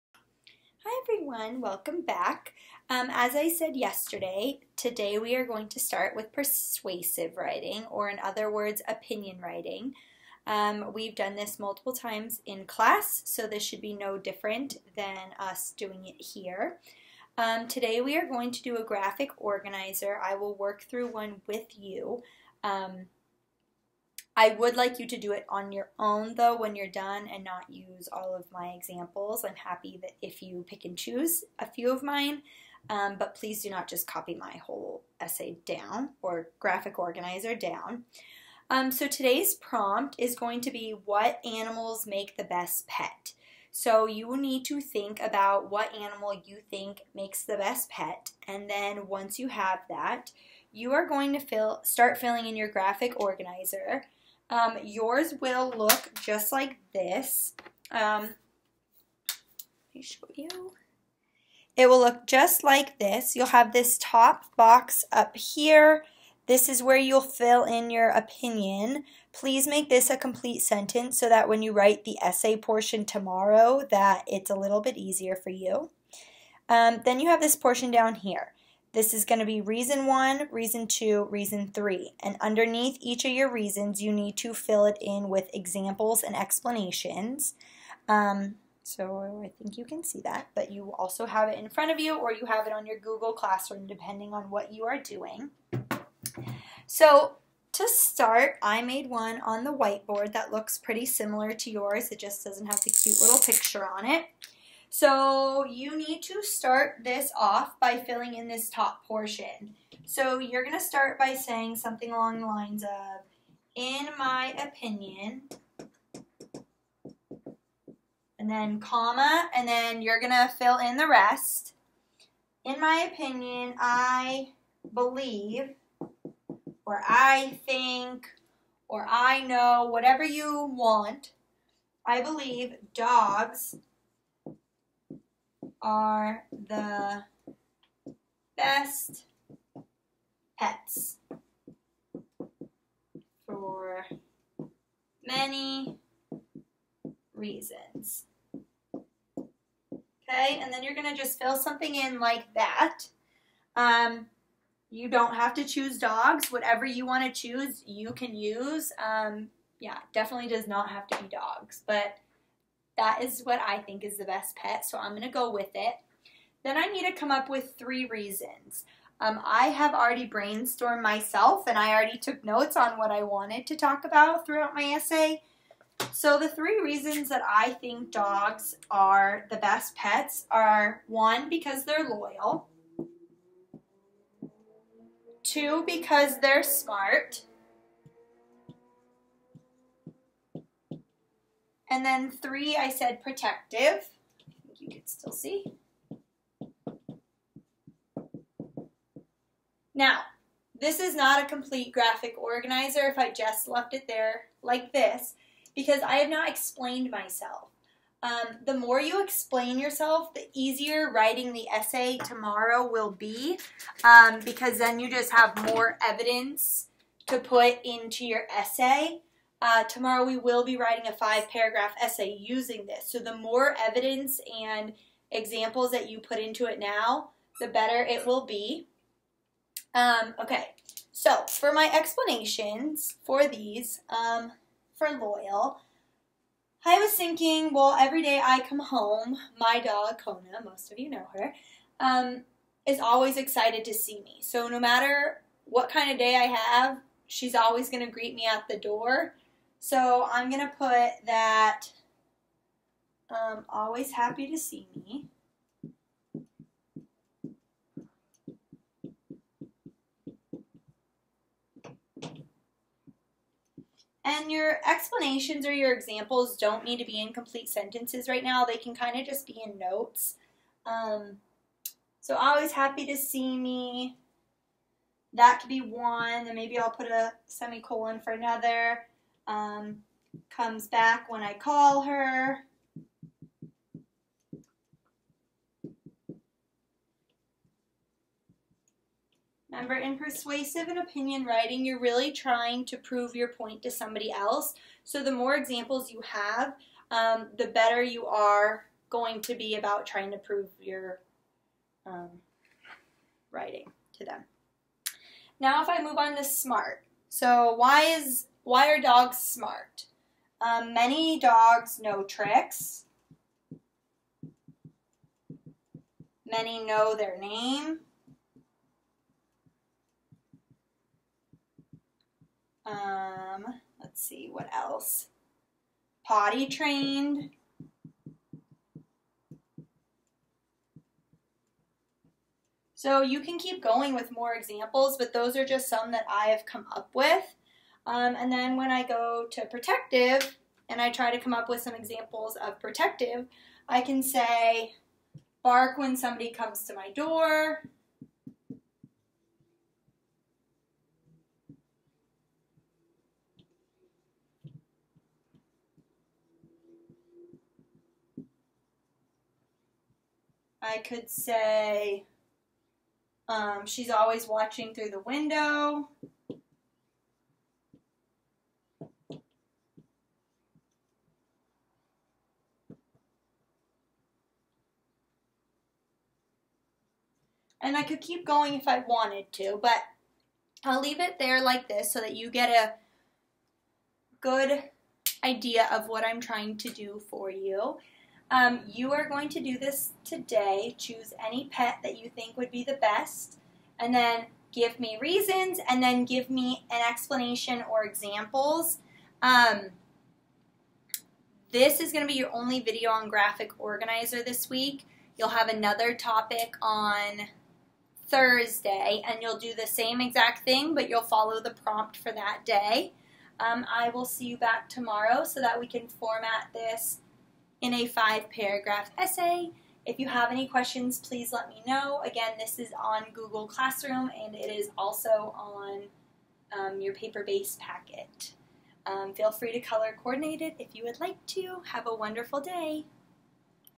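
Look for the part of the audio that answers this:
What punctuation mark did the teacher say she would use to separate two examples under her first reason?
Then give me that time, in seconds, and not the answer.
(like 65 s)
277 s.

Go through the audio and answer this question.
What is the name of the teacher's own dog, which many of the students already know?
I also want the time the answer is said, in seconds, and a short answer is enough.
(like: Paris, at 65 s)
Kona, at 240 s.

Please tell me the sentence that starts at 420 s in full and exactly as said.
If you have any questions, please let me know.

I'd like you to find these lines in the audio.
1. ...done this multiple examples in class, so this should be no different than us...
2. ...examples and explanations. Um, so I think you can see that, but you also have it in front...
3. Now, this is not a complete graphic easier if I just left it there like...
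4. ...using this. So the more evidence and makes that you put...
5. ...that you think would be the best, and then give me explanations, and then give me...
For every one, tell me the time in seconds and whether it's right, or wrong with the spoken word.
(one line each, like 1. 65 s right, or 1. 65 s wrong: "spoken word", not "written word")
1. 11 s wrong: "times", not "examples"
2. 85 s right
3. 199 s wrong: "organizer", not "easier"
4. 222 s wrong: "examples", not "makes"
5. 392 s wrong: "reasons", not "explanations".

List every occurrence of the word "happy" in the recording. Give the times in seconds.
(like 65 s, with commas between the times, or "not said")
29 s, 254 s, 272 s.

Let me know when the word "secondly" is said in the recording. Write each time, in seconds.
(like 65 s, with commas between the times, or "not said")
not said.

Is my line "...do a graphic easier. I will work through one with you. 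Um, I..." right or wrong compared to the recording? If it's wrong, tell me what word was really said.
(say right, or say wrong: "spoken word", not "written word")
wrong: "organizer", not "easier".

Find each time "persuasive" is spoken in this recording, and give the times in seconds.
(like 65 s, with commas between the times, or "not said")
6 s, 290 s.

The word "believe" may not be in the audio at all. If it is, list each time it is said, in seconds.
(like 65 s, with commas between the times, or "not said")
124 s, 132 s.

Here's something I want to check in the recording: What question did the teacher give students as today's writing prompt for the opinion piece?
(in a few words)
What animals make the best pet.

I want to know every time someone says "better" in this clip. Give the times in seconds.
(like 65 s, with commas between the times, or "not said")
227 s, 297 s.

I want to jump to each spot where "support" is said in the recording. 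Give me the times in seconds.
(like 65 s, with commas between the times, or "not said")
not said.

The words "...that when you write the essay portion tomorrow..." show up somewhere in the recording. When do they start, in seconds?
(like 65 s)
71 s.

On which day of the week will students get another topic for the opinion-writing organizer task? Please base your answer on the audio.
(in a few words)
Thursday.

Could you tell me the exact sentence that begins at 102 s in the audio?
It just doesn't have the cute little picture on it.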